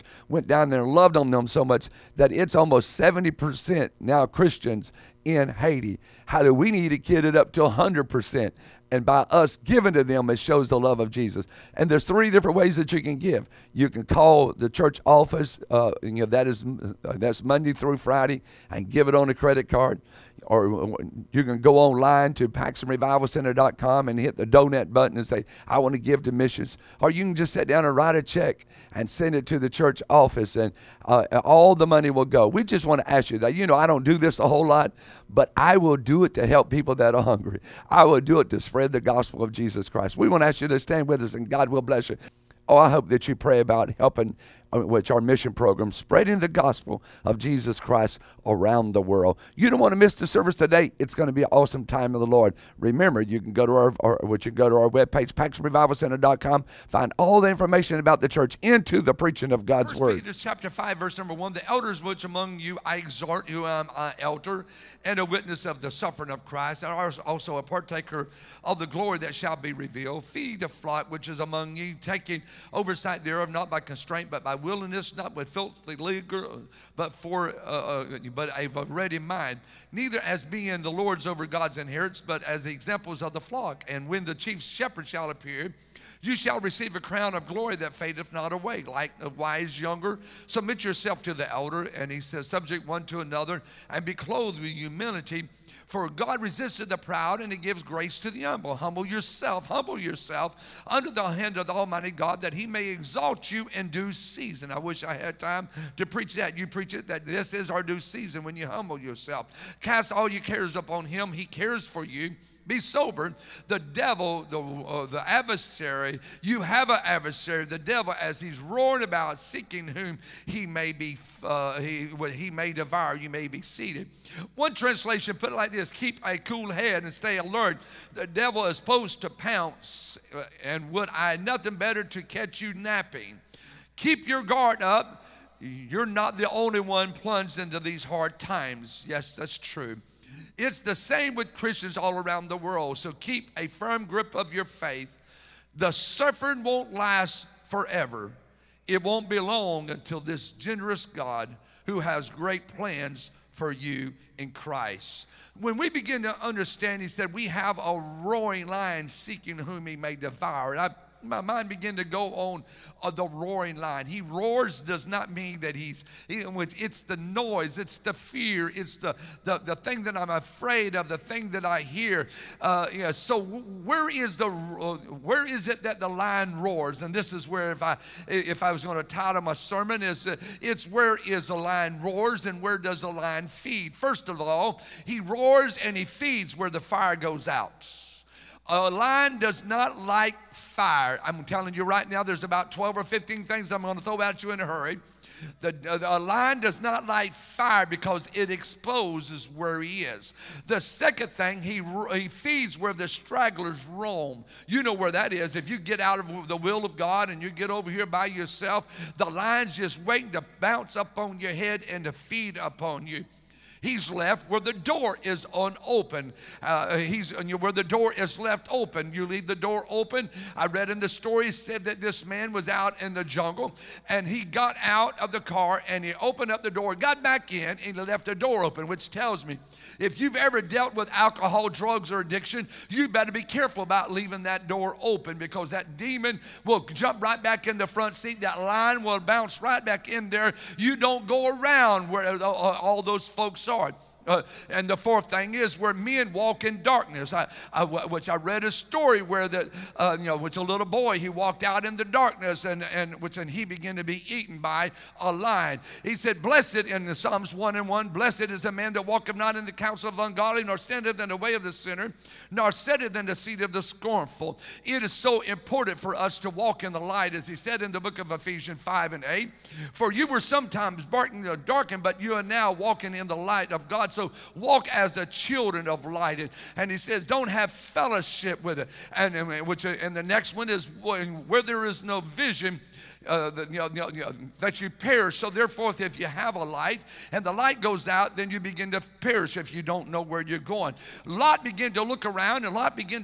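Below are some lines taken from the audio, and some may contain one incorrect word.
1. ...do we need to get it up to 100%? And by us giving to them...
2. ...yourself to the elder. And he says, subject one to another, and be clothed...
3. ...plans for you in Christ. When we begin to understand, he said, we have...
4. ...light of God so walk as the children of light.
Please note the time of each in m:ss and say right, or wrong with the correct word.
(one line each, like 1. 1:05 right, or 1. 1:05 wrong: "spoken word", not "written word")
1. 0:06 right
2. 1:30 right
3. 2:32 right
4. 4:33 right.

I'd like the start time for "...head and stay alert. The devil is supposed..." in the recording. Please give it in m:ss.
2:06.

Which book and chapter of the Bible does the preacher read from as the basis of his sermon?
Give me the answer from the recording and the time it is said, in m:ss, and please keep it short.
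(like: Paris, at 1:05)
1 Peter 5, at 1:00.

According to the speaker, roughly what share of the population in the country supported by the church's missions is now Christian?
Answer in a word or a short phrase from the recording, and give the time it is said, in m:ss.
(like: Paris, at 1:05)
70%, at 0:02.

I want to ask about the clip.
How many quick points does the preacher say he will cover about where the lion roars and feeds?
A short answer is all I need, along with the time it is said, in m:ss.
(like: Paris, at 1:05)
12 or 15, at 3:12.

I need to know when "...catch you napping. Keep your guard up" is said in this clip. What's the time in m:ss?
2:12.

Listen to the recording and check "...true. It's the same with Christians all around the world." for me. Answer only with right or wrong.
right.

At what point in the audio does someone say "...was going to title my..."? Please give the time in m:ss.
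2:58.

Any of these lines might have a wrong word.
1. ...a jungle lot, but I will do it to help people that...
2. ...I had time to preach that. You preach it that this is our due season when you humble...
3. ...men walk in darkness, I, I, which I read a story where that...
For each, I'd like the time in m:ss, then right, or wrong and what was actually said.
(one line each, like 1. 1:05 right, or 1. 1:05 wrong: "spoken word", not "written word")
1. 0:34 wrong: "whole", not "jungle"
2. 1:45 right
3. 4:05 right.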